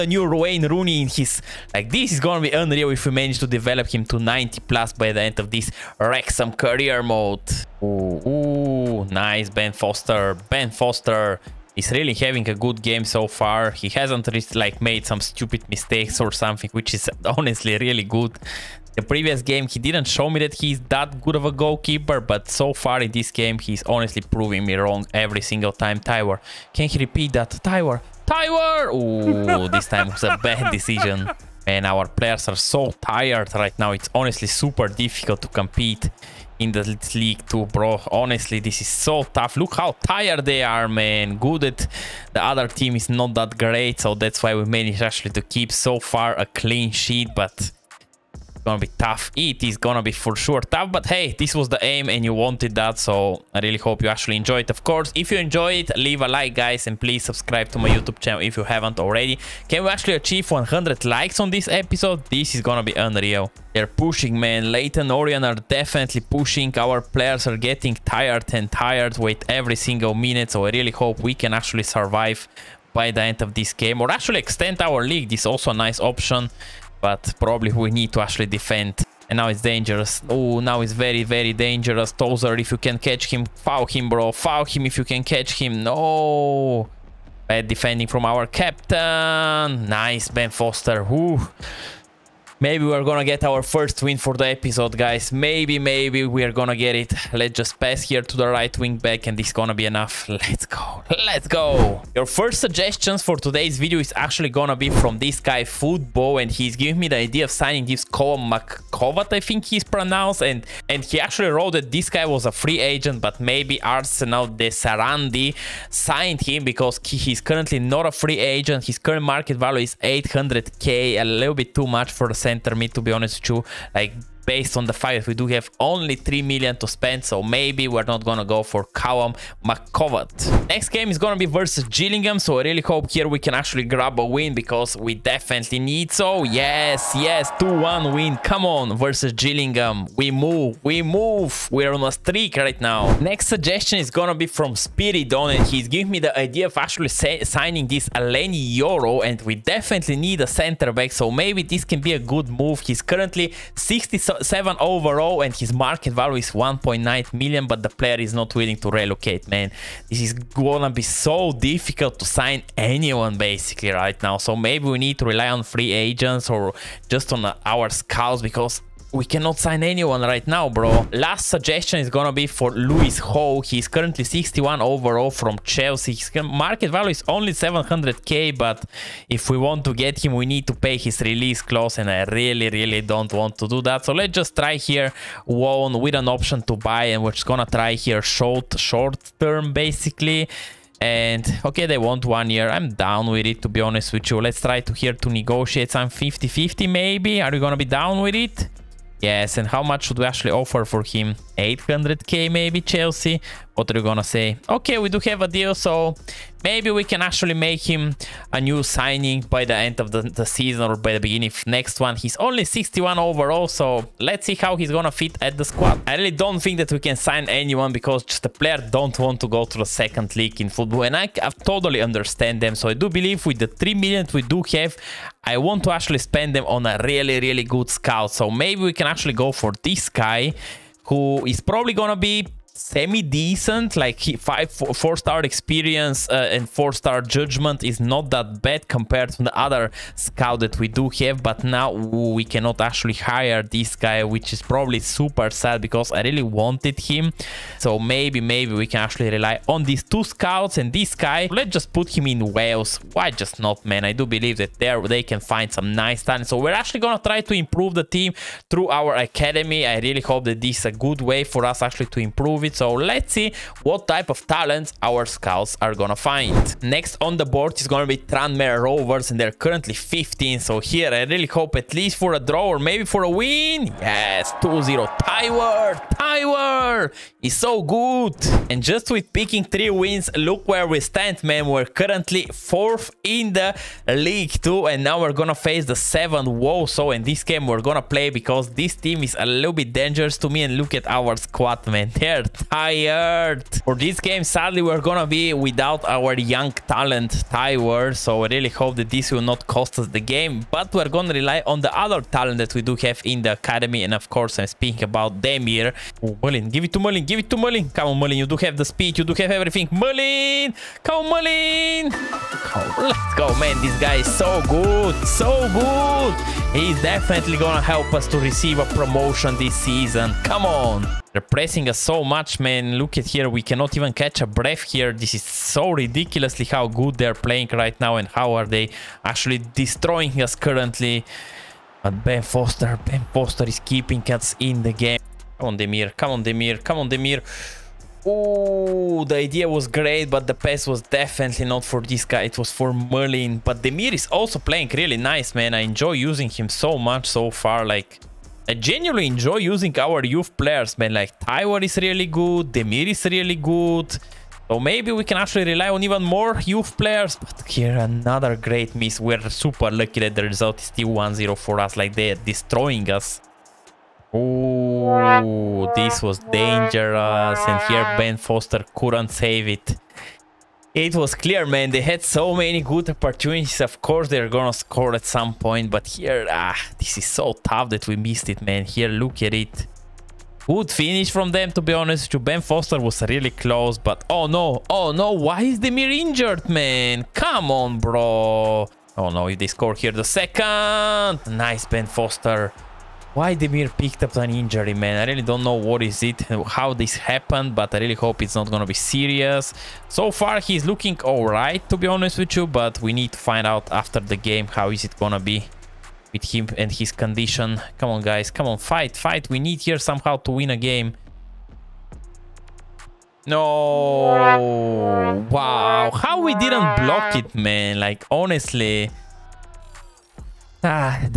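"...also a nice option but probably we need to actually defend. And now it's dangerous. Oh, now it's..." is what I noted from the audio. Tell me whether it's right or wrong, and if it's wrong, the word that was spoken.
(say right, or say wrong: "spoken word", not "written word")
right.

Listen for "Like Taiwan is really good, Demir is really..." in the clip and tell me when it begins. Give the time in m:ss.
5:51.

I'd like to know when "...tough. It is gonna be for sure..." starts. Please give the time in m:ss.
0:49.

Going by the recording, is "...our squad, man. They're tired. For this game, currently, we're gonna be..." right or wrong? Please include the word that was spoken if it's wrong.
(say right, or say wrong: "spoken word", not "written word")
wrong: "sadly", not "currently".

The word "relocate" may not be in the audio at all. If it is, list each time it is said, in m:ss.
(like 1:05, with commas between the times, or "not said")
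2:38.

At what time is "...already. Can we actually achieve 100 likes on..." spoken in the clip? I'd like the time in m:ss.
0:58.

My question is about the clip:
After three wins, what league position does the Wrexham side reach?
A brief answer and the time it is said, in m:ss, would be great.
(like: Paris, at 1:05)
Fourth, at 4:42.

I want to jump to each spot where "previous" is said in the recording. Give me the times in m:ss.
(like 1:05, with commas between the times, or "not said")
0:19.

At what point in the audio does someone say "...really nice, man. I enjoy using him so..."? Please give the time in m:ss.
5:44.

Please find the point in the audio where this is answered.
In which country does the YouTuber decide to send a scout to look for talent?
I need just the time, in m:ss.
4:12.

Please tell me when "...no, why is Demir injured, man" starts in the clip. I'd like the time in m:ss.
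6:25.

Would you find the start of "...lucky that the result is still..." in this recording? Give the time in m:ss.
5:59.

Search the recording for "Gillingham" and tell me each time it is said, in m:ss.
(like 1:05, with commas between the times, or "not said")
2:11, 2:19.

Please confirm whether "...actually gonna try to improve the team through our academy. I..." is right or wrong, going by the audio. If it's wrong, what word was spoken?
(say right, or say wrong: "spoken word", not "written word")
right.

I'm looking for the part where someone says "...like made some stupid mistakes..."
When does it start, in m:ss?
0:14.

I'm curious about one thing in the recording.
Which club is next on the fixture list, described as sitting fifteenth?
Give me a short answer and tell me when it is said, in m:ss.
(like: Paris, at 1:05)
Tranmere Rovers, at 4:28.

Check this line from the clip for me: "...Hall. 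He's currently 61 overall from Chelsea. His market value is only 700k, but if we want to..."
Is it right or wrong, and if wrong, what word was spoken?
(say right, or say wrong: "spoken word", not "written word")
right.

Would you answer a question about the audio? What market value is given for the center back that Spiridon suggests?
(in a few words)
1.9 million.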